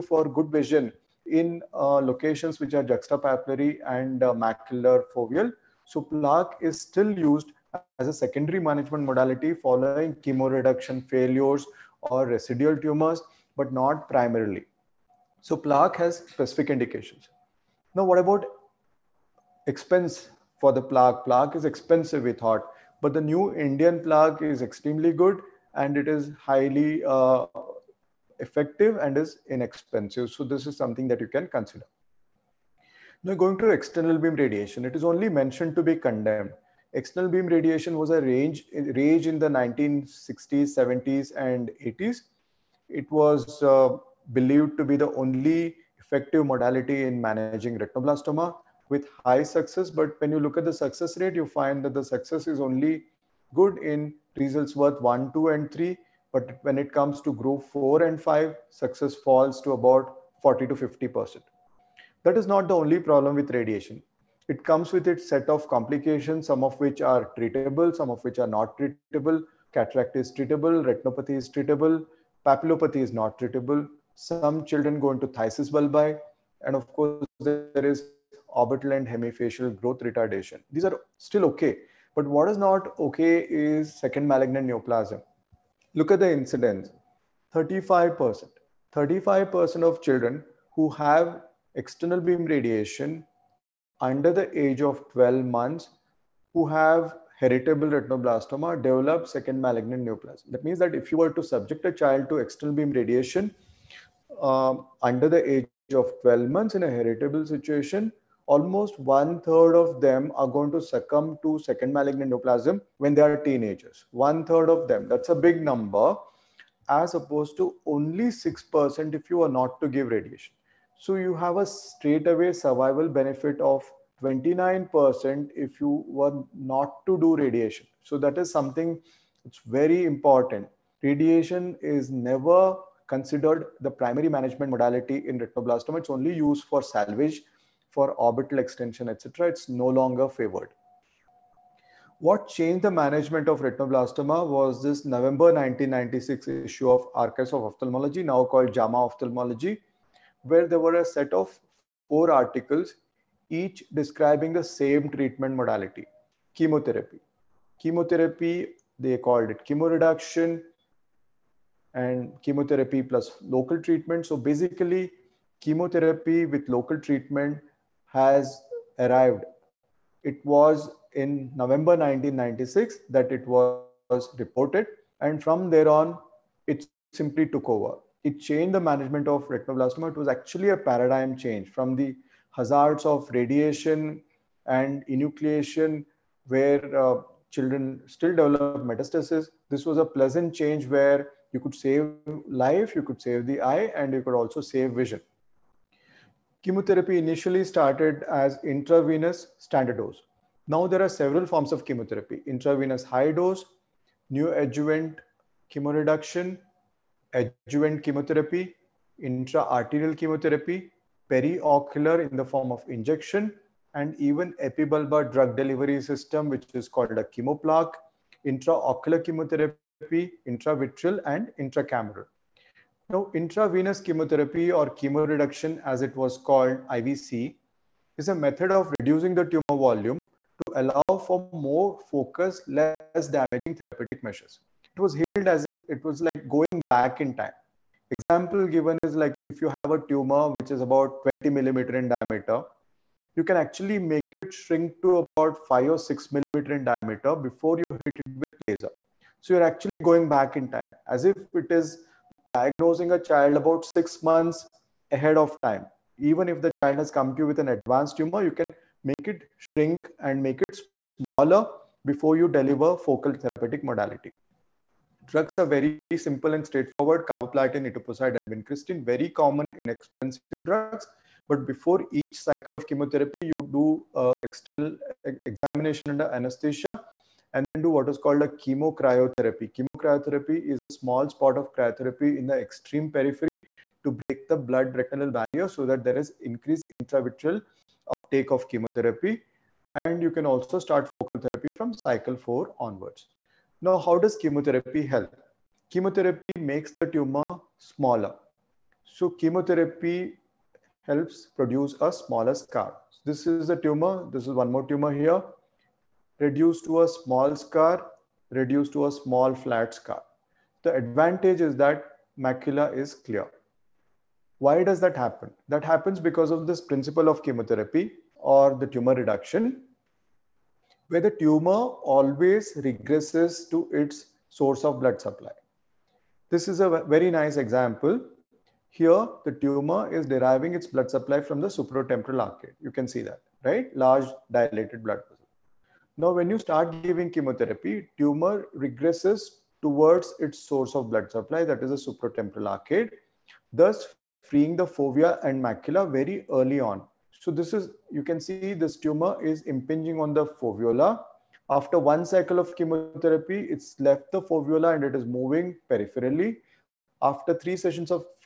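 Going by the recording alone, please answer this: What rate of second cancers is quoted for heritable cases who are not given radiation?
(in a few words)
6%.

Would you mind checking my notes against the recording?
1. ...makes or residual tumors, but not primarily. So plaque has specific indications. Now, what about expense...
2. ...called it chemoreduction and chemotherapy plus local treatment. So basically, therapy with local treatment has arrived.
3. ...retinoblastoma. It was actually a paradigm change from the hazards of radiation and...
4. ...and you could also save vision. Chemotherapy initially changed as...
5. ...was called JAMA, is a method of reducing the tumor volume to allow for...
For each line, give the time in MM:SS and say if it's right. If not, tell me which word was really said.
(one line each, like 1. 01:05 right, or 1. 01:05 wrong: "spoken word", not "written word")
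1. 00:11 wrong: "failures", not "makes"
2. 02:39 wrong: "chemotherapy", not "therapy"
3. 02:59 right
4. 03:14 wrong: "started", not "changed"
5. 03:46 wrong: "IVC", not "JAMA".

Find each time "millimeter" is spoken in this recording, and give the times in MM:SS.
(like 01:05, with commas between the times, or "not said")
04:01, 04:06.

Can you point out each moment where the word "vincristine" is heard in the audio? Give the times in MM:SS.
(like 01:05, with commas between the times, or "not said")
04:28.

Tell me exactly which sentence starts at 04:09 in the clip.
So you're actually going back in time as if it is diagnosing a child about six months ahead of time.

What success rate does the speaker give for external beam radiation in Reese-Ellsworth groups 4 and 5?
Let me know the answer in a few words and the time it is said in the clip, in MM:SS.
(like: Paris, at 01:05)
40 to 50%, at 01:00.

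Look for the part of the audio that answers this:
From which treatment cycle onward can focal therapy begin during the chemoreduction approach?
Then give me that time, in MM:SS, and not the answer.
04:51.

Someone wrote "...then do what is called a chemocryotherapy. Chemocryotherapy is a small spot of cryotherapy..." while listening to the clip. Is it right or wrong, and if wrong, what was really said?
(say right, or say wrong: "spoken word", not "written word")
right.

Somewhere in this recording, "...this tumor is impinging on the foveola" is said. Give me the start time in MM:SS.
05:48.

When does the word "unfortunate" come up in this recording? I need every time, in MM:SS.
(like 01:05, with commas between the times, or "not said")
not said.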